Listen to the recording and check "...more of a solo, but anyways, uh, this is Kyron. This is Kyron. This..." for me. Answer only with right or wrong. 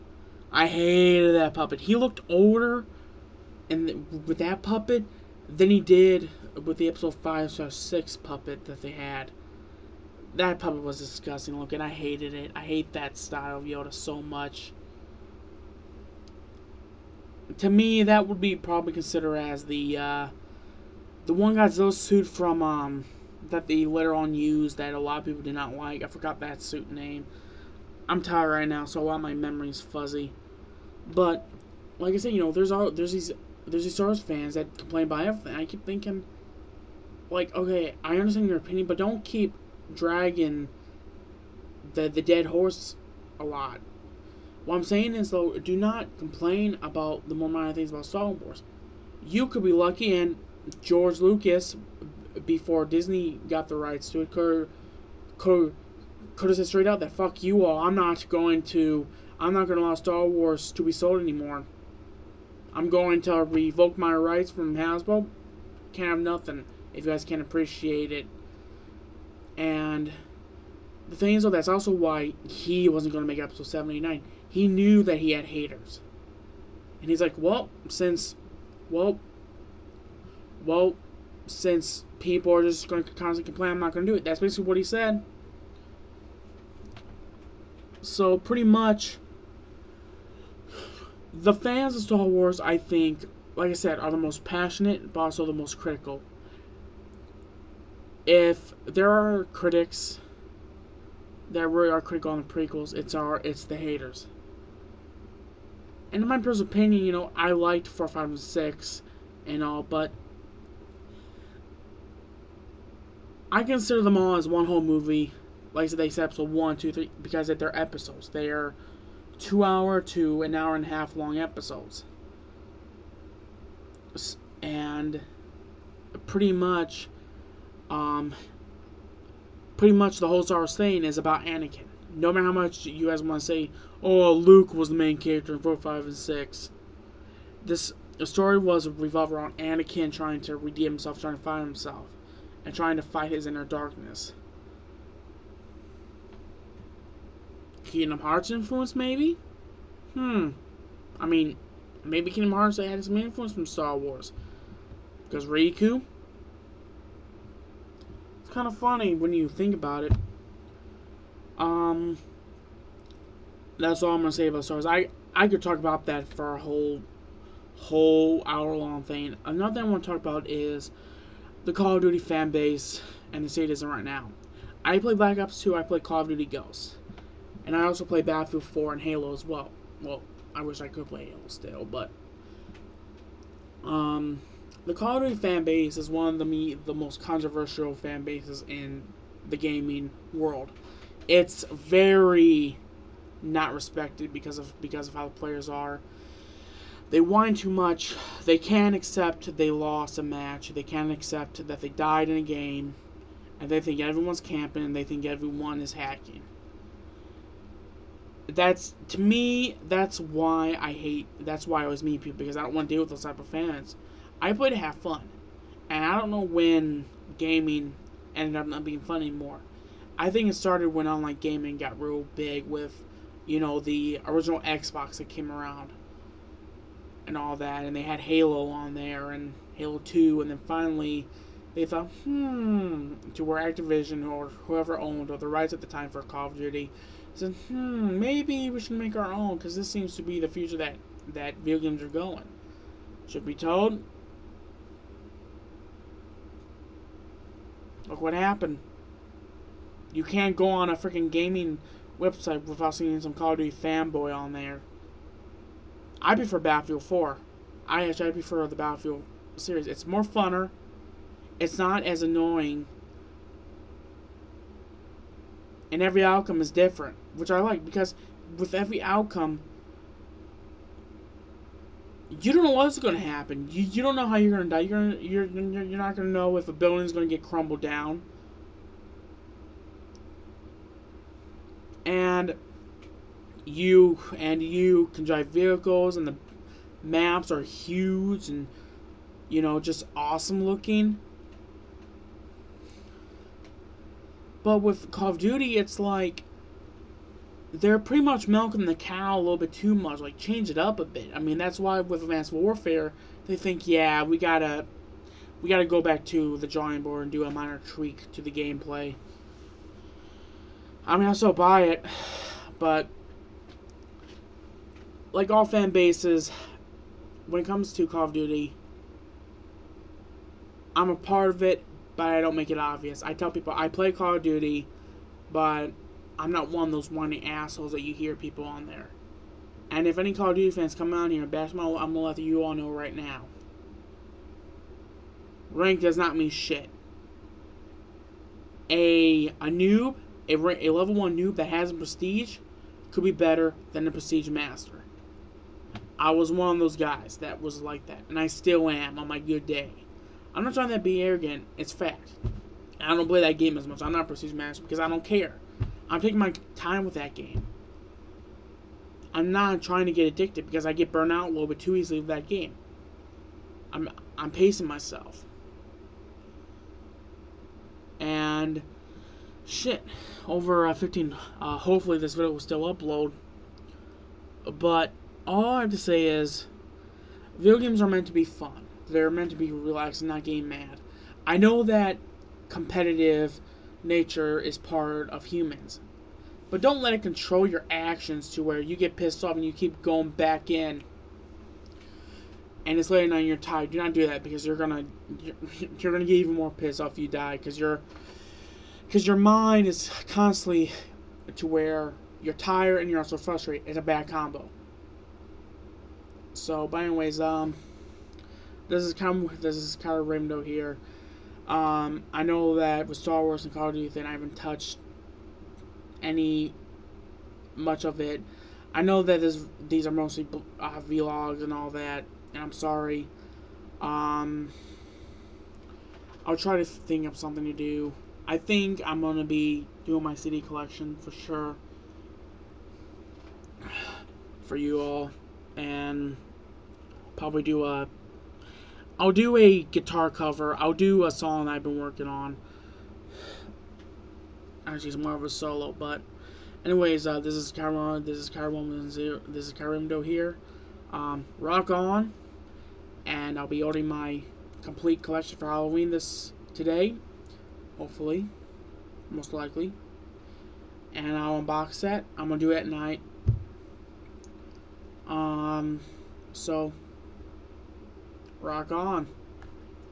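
right.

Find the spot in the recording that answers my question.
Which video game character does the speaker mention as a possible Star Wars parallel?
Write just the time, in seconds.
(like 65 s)
155 s.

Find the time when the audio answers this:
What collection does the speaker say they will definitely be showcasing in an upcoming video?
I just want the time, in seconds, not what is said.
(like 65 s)
430 s.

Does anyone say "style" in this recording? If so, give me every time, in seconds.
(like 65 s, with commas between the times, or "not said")
13 s.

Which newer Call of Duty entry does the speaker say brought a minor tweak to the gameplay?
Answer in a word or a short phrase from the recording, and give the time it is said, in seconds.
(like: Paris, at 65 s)
Advanced Warfare, at 302 s.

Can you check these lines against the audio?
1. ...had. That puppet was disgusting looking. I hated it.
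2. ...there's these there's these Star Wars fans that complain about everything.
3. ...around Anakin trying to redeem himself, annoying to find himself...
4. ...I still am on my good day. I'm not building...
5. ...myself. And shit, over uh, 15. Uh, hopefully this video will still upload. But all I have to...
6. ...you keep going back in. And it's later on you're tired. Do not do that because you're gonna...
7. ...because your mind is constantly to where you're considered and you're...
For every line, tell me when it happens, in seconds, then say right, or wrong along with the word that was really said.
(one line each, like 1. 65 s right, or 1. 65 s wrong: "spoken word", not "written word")
1. 8 s right
2. 32 s right
3. 139 s wrong: "trying", not "annoying"
4. 348 s wrong: "trying", not "building"
5. 364 s right
6. 389 s right
7. 399 s wrong: "tired", not "considered".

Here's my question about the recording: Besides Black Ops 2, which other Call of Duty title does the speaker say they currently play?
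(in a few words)
Call of Duty Ghosts.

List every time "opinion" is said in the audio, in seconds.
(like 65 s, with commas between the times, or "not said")
38 s, 106 s.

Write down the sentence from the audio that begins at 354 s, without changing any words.
I'm not prestige manager because I don't care.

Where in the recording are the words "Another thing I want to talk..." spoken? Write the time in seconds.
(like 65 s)
169 s.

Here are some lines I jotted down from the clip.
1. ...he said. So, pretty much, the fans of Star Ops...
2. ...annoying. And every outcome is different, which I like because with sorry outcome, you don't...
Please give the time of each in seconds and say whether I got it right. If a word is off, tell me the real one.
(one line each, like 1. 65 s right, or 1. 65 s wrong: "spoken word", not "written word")
1. 84 s wrong: "Wars", not "Ops"
2. 262 s wrong: "every", not "sorry".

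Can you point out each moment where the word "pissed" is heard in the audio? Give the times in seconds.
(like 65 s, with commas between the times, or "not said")
389 s, 396 s.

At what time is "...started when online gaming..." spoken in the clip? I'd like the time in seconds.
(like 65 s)
220 s.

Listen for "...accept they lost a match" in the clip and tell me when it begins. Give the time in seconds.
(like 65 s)
198 s.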